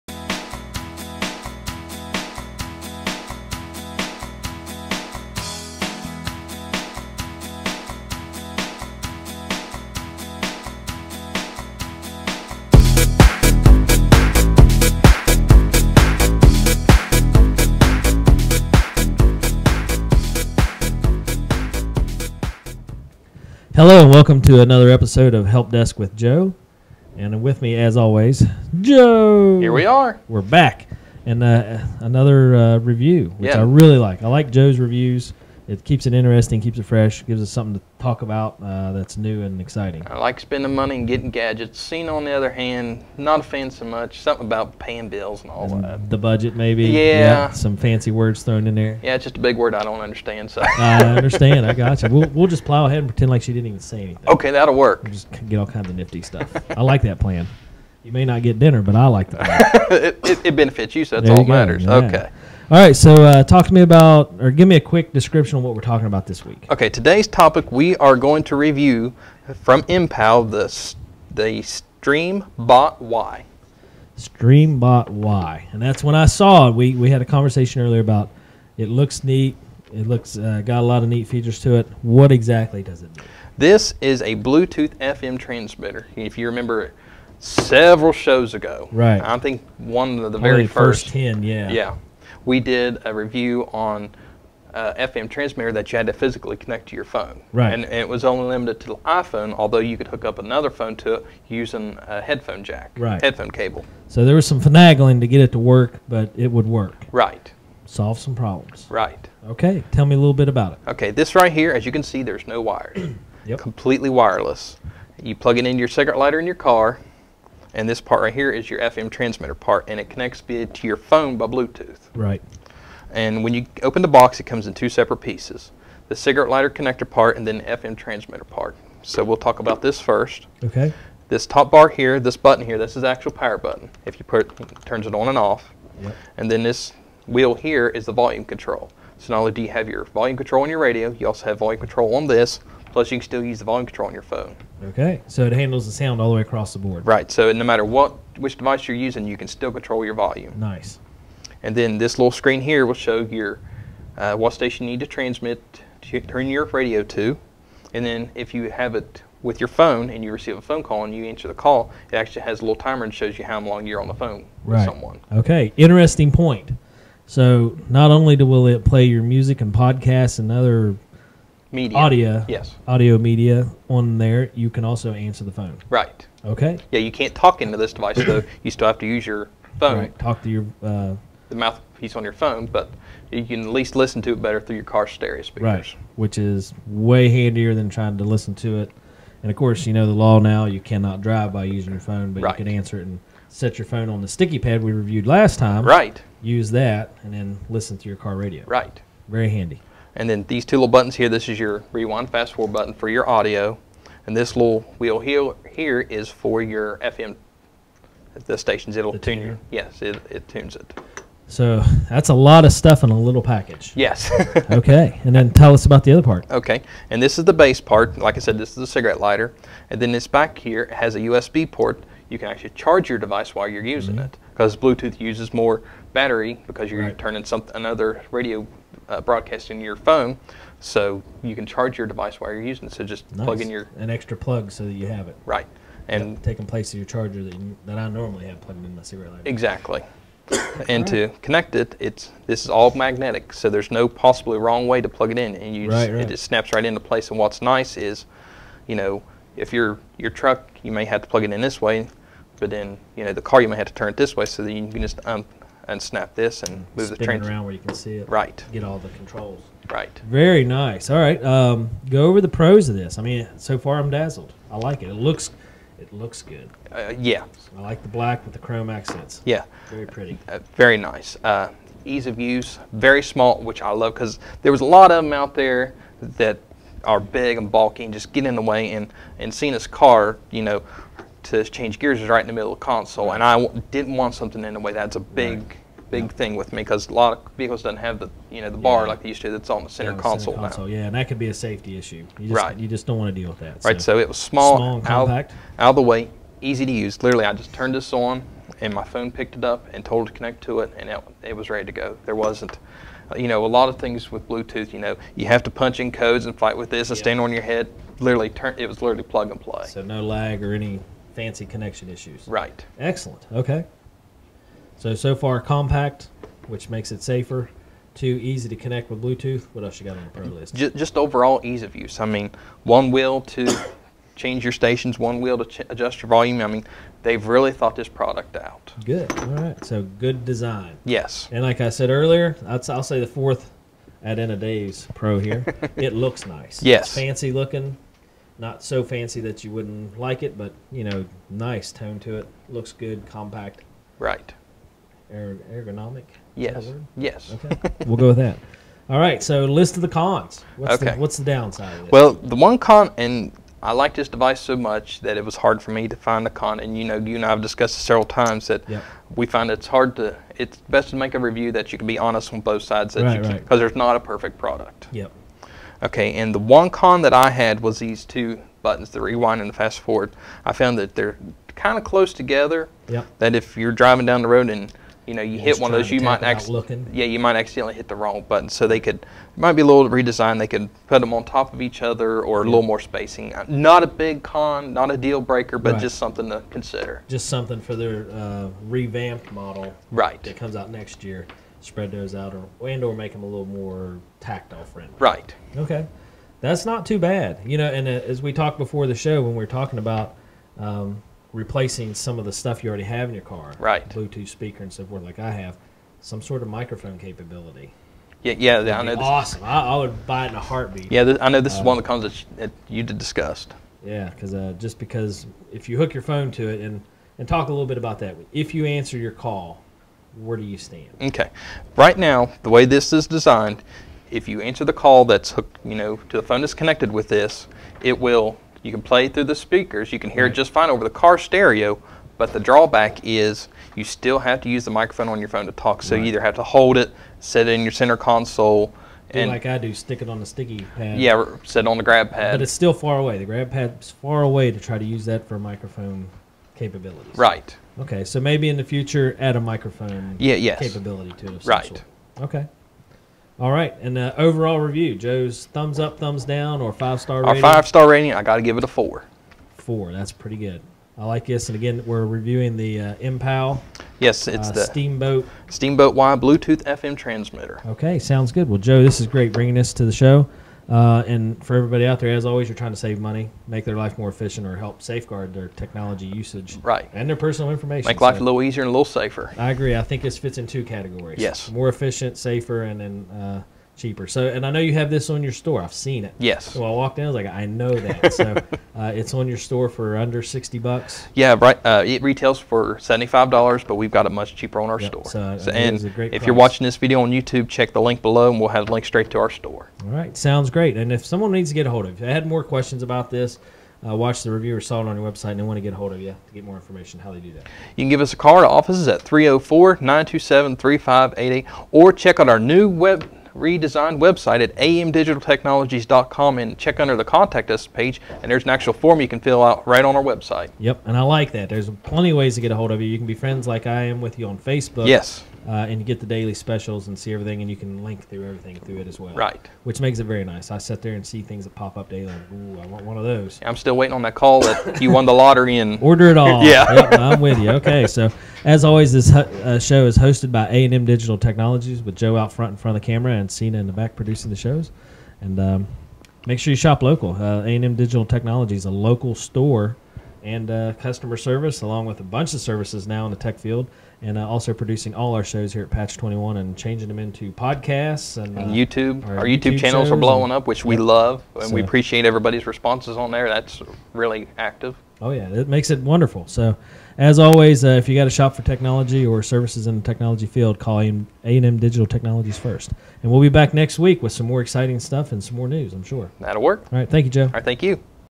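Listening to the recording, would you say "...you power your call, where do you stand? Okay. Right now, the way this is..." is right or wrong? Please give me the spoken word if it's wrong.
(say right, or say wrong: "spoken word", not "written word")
wrong: "answer", not "power".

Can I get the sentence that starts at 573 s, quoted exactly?
And we'll be back next week with some more exciting stuff and some more news.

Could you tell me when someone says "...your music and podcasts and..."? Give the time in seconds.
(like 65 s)
169 s.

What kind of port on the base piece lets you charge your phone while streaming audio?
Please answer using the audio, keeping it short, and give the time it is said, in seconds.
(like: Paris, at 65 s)
USB port, at 221 s.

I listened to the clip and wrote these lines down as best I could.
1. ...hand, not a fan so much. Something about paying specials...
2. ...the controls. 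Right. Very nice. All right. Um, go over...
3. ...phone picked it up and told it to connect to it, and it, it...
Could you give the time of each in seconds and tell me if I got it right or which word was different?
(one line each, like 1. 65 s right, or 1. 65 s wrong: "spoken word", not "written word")
1. 42 s wrong: "bills", not "specials"
2. 258 s right
3. 299 s right.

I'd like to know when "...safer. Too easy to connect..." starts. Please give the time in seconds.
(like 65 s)
317 s.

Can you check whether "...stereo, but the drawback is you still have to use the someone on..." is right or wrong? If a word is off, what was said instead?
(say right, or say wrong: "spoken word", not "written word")
wrong: "microphone", not "someone".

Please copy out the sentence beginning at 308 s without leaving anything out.
Literally, turn it was literally plug and play.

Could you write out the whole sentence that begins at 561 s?
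we appreciate everybody's responses on there.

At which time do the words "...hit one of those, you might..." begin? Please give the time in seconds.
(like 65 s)
375 s.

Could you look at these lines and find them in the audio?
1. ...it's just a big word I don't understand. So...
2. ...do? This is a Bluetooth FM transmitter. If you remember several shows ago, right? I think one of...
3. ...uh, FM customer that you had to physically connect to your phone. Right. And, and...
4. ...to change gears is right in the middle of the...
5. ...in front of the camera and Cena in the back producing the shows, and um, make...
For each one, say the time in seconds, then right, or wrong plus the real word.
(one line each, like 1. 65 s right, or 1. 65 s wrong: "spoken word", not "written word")
1. 49 s right
2. 83 s right
3. 94 s wrong: "transmitter", not "customer"
4. 281 s right
5. 542 s right.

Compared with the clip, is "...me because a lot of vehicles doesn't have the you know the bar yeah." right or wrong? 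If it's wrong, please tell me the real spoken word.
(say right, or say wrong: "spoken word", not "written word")
right.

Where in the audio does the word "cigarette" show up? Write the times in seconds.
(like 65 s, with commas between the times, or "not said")
115 s, 126 s, 218 s.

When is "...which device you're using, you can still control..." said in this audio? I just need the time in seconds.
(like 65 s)
148 s.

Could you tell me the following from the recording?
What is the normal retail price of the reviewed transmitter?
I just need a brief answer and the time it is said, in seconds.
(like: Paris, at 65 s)
$75, at 492 s.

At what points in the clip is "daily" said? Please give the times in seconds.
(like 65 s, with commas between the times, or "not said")
526 s, 532 s.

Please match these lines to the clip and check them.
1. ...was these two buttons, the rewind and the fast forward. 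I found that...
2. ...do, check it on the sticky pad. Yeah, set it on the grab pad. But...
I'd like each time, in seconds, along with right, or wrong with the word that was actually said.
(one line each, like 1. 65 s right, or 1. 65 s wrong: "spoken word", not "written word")
1. 367 s right
2. 439 s wrong: "stick", not "check".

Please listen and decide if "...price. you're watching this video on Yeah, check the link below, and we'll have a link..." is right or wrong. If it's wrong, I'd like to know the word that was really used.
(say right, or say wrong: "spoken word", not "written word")
wrong: "YouTube", not "Yeah".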